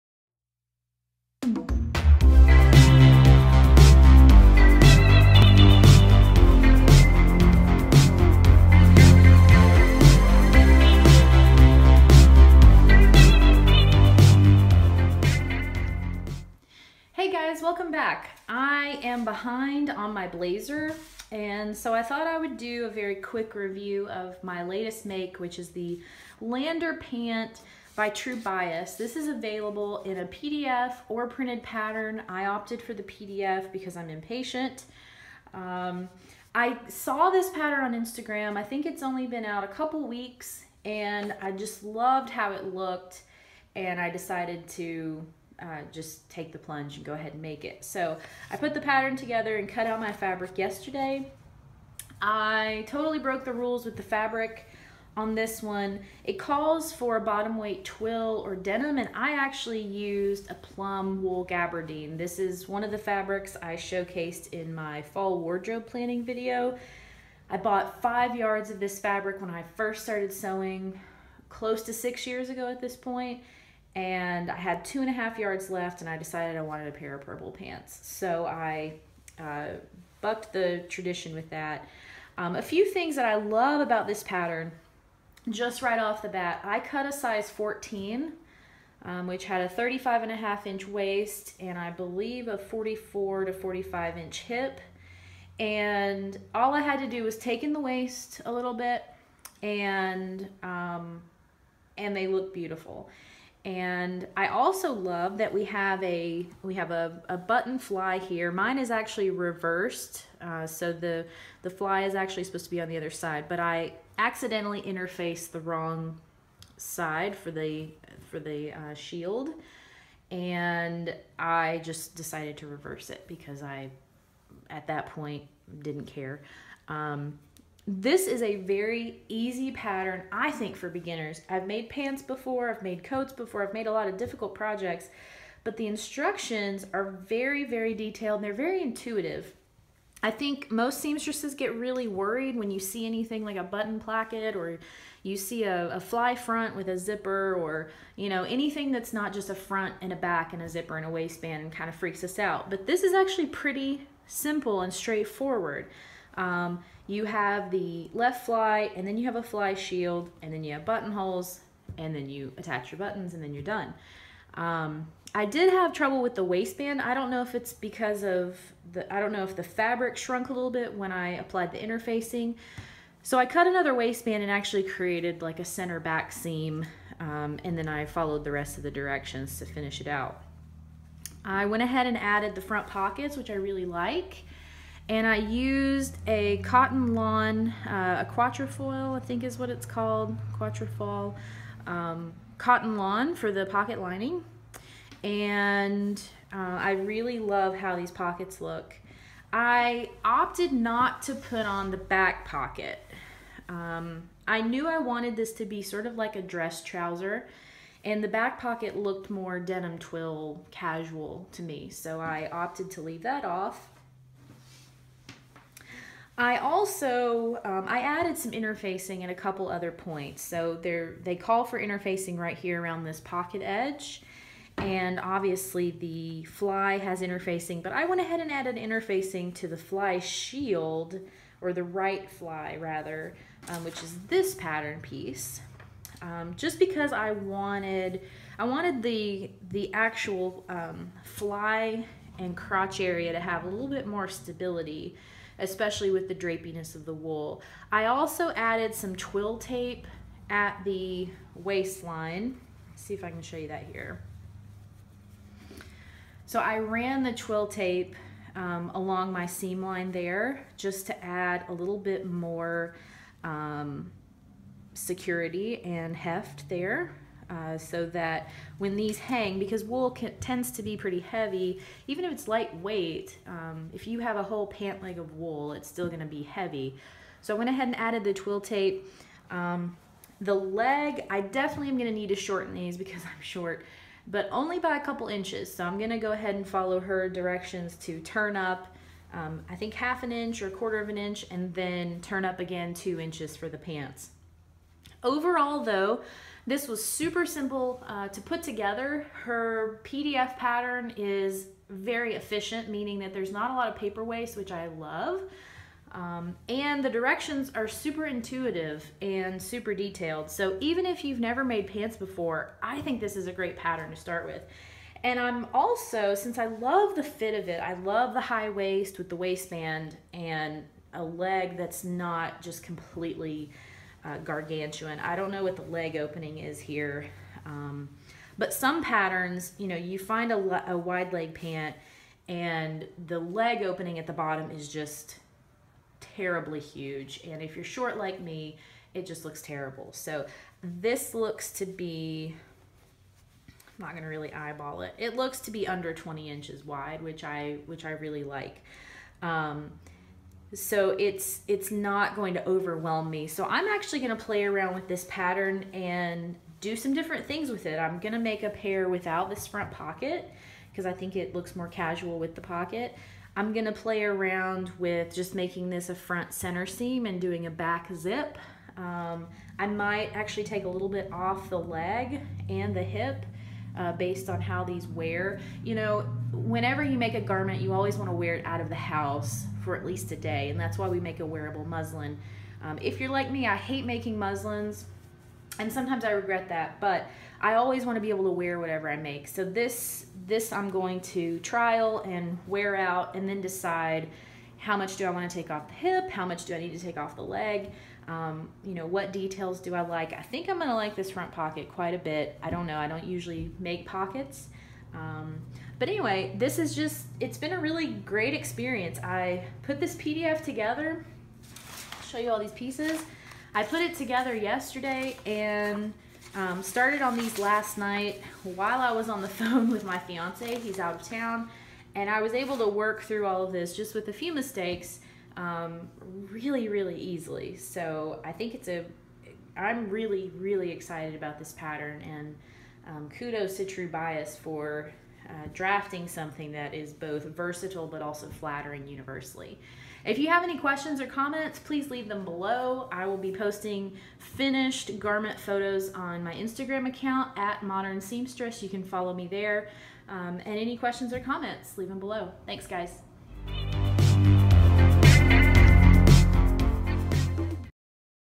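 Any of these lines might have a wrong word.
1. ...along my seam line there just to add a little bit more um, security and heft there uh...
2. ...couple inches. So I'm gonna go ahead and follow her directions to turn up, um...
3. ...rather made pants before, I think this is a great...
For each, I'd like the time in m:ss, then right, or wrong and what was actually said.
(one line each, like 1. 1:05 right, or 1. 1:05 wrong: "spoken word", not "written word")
1. 4:18 right
2. 4:45 right
3. 5:11 wrong: "never", not "rather".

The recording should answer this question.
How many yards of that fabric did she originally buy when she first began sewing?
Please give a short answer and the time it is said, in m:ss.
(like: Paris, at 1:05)
5, at 1:08.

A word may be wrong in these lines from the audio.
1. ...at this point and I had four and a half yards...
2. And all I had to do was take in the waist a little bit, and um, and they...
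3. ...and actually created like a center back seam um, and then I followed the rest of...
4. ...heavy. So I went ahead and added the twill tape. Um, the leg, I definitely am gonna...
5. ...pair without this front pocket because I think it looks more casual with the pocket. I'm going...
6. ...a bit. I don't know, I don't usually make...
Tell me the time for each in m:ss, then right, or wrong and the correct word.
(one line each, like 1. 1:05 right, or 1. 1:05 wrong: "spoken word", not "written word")
1. 1:12 wrong: "two", not "four"
2. 1:35 right
3. 2:54 right
4. 4:36 right
5. 5:58 right
6. 6:42 right.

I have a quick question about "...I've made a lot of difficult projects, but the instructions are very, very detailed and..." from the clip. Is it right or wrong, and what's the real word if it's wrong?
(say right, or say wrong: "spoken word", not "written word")
right.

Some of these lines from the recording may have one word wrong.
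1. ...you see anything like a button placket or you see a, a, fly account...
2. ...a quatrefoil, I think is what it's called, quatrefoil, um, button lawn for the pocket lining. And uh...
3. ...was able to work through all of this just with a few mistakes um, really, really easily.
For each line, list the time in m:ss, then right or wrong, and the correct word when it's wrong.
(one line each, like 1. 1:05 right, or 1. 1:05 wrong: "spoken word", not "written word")
1. 2:22 wrong: "front", not "account"
2. 3:08 wrong: "cotton", not "button"
3. 7:02 right.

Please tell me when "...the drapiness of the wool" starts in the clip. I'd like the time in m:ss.
4:06.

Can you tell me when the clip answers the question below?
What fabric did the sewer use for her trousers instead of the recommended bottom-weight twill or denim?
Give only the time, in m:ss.
1:00.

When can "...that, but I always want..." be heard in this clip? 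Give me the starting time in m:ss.
6:26.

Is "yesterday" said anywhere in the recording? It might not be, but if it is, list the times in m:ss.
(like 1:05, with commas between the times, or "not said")
0:50, 6:54.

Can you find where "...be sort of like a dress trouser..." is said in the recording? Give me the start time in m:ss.
3:25.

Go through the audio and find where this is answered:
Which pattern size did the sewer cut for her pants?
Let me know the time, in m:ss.
1:27.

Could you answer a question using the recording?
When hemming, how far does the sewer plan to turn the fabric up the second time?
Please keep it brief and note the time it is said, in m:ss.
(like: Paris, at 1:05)
2 inches, at 4:52.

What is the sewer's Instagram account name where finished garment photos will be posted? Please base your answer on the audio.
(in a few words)
Modern Seamstress.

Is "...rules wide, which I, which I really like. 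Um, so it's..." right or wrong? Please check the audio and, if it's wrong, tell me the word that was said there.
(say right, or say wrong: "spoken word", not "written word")
wrong: "inches", not "rules".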